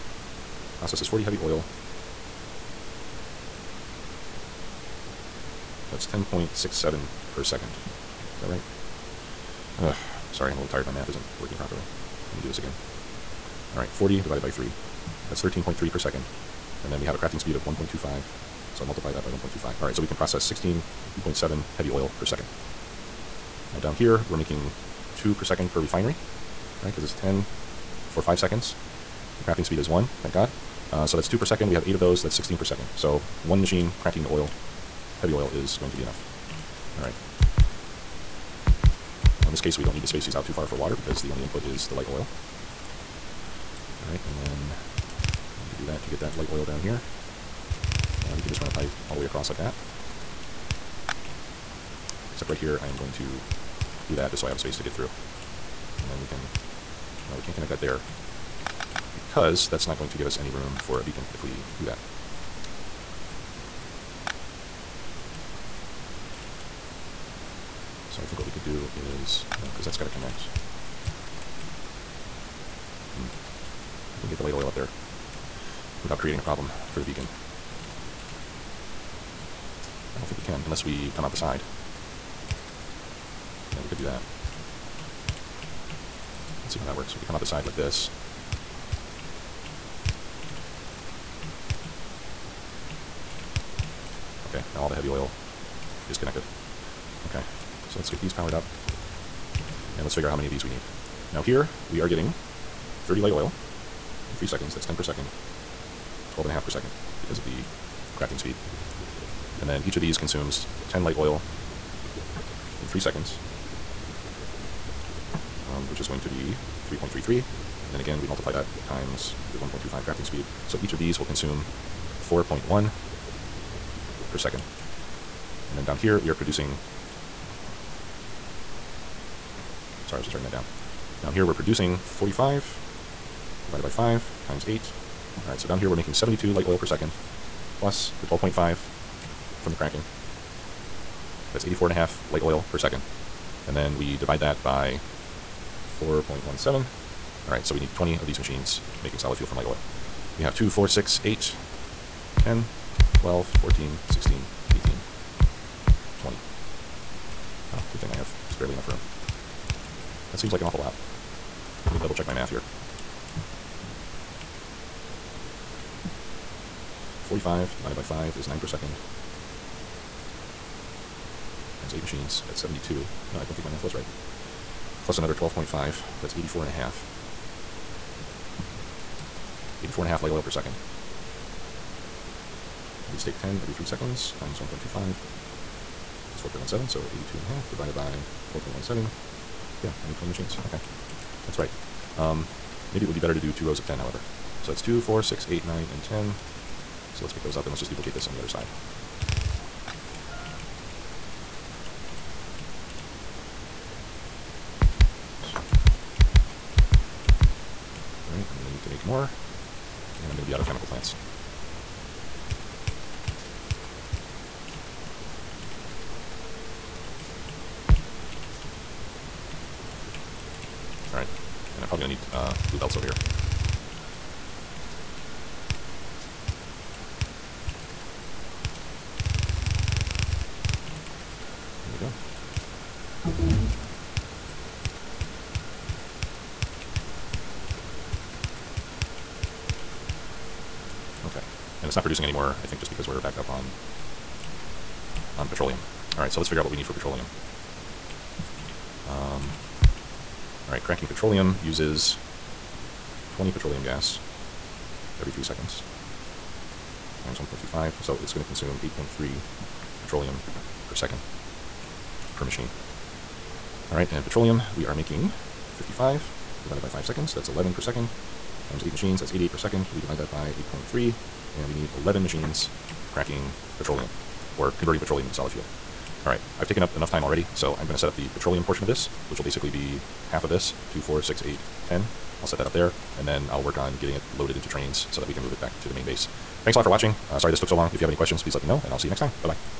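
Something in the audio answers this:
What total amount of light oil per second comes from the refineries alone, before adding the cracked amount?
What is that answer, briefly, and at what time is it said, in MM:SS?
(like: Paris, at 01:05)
72, at 02:16.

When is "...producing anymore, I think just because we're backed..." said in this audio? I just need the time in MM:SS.
04:02.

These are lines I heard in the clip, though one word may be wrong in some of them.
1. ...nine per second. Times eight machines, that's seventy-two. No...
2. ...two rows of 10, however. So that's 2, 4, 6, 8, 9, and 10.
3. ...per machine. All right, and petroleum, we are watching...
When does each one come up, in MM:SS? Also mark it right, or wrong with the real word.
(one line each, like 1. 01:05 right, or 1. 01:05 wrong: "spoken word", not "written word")
1. 02:48 right
2. 03:13 right
3. 04:22 wrong: "making", not "watching".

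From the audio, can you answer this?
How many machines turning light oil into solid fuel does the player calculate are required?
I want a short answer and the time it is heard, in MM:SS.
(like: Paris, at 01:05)
20, at 02:27.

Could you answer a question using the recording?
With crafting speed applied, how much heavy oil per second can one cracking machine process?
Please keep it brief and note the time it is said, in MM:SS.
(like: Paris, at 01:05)
16.7, at 00:20.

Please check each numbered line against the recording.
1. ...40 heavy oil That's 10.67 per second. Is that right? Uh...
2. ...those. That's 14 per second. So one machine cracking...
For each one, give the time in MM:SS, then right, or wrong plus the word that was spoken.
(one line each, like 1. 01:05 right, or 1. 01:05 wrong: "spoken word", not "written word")
1. 00:01 right
2. 00:32 wrong: "16", not "14".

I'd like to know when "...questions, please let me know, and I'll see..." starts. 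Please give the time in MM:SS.
04:48.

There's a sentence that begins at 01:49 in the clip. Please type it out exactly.
And then each of these consumes 10 light oil in 3 seconds.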